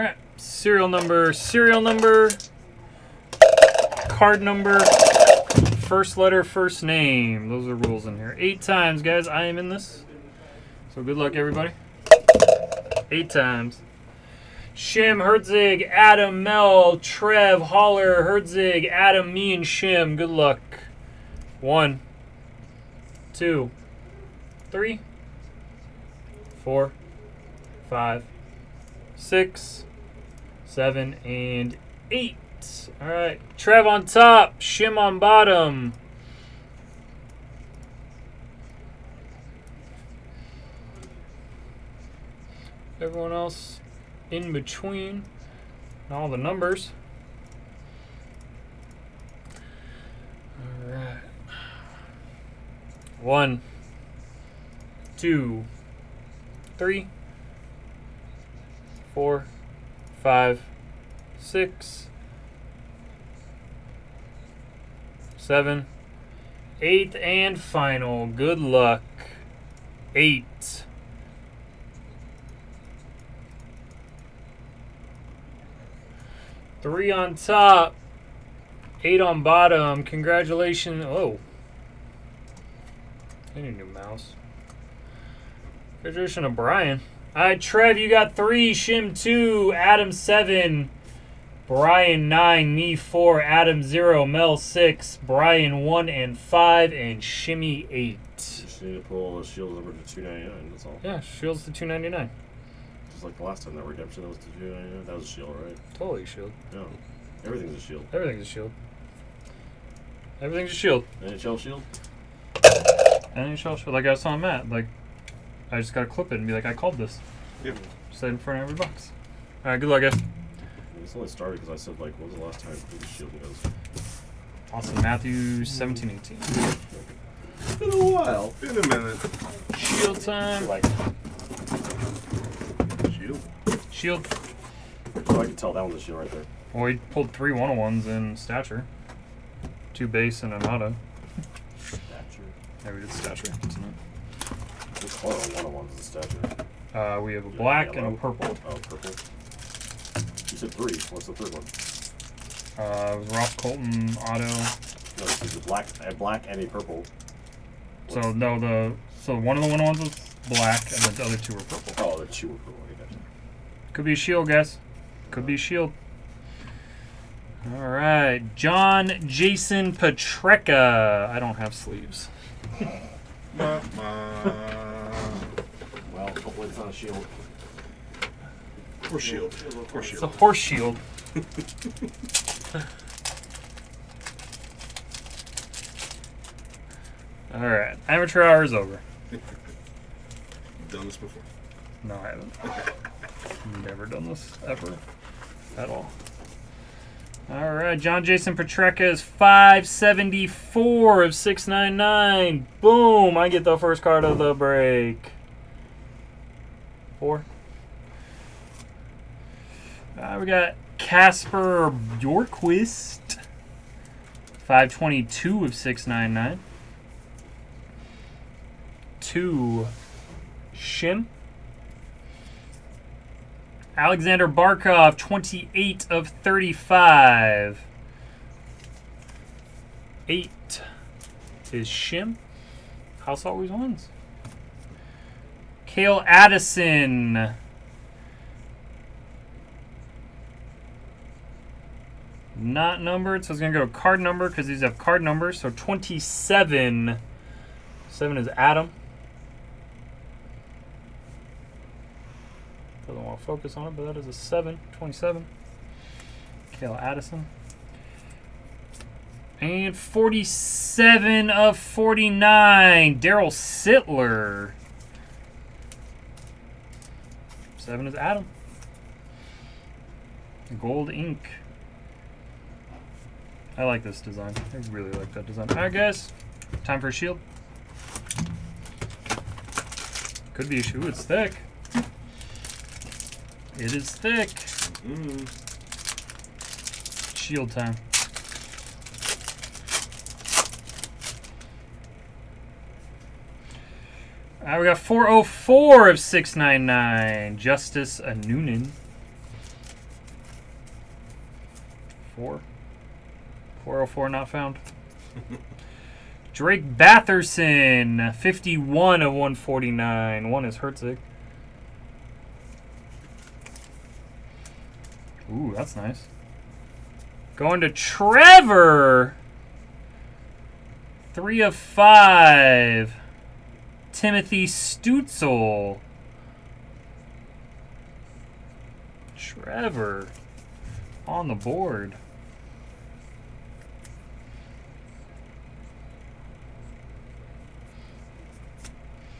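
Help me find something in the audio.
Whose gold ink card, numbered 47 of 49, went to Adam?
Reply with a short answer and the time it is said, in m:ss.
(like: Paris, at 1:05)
Darryl Sittler, at 4:23.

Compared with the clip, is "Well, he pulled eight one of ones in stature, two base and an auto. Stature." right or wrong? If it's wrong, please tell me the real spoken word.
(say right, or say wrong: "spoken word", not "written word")
wrong: "three", not "eight".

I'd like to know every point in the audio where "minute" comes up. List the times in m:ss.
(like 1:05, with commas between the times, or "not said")
2:08.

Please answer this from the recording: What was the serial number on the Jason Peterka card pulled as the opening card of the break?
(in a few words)
574 of 699.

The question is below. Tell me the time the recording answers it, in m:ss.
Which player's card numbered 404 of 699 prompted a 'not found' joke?
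4:57.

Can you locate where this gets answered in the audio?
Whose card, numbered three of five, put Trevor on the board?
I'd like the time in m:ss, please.
5:24.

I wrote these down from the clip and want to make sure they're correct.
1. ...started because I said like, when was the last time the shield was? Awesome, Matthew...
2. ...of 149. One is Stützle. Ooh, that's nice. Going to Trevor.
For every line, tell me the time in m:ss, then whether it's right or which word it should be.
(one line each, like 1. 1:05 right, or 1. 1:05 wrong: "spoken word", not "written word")
1. 2:01 right
2. 5:09 wrong: "Herzig", not "Stützle".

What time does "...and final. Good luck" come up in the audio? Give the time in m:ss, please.
1:07.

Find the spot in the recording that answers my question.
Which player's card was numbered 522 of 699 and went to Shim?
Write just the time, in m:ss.
3:30.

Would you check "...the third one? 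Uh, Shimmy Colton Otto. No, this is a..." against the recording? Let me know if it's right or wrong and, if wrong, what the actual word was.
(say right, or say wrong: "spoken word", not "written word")
wrong: "Roth", not "Shimmy".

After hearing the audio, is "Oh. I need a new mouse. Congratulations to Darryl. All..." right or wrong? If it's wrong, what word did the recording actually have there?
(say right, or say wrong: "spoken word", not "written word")
wrong: "Brian", not "Darryl".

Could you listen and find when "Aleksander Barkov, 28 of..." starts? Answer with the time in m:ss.
3:43.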